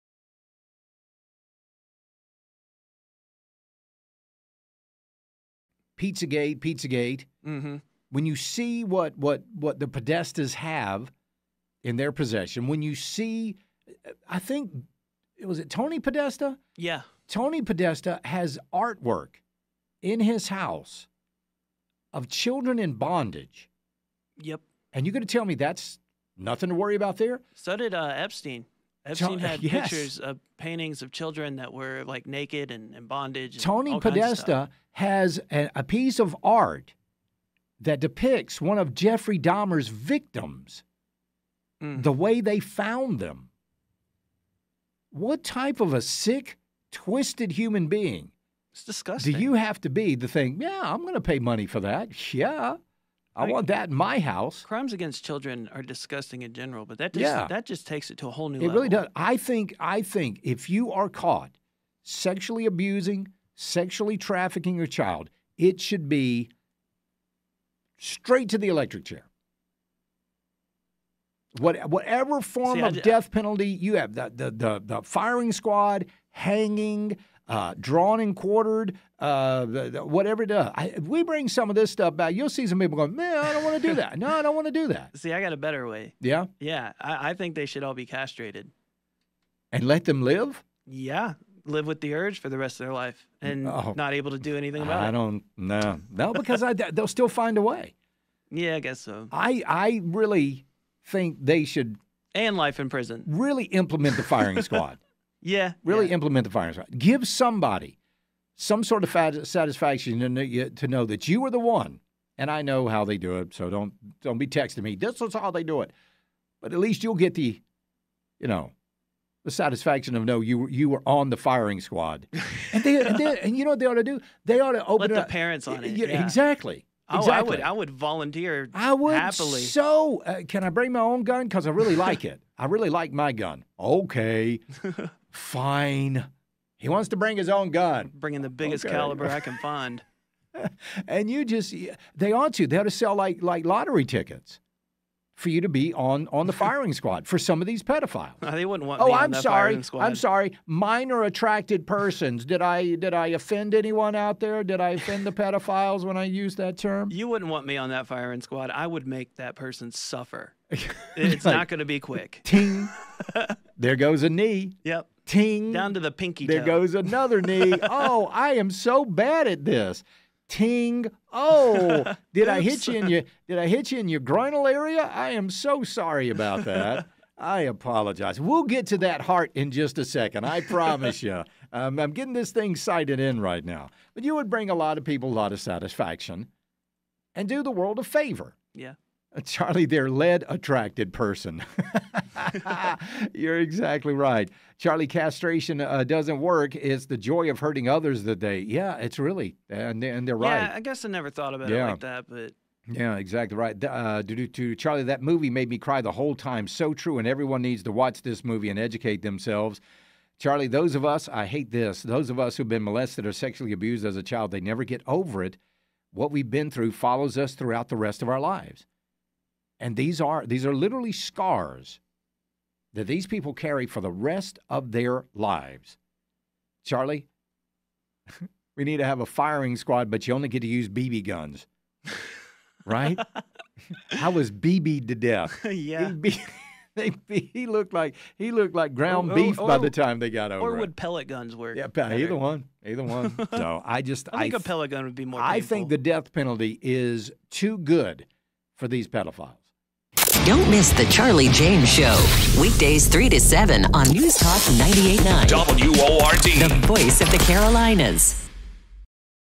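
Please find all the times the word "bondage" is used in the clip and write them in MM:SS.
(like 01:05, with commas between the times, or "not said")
00:22, 00:33.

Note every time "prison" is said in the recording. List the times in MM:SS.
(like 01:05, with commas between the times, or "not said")
01:42.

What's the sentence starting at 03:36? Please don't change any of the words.
What we've been through follows us throughout the rest of our lives.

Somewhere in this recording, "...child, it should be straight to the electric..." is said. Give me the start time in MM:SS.
01:04.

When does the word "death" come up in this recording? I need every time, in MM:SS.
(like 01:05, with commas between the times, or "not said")
01:12, 03:55, 04:05.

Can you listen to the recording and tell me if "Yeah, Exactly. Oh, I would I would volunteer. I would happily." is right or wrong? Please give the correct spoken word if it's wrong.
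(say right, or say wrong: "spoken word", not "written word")
right.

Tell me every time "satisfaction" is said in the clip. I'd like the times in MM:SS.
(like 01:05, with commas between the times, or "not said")
01:49, 01:59, 03:05.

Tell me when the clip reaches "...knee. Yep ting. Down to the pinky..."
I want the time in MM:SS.
02:44.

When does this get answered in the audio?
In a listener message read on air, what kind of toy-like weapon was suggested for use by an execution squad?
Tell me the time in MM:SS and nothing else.
03:50.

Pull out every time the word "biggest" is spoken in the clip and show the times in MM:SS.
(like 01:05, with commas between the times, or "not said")
02:18.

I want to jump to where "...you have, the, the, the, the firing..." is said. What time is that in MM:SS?
01:13.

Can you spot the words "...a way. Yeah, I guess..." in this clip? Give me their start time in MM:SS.
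01:37.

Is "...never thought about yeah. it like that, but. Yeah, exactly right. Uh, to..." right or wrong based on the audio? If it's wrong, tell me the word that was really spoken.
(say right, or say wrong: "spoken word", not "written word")
right.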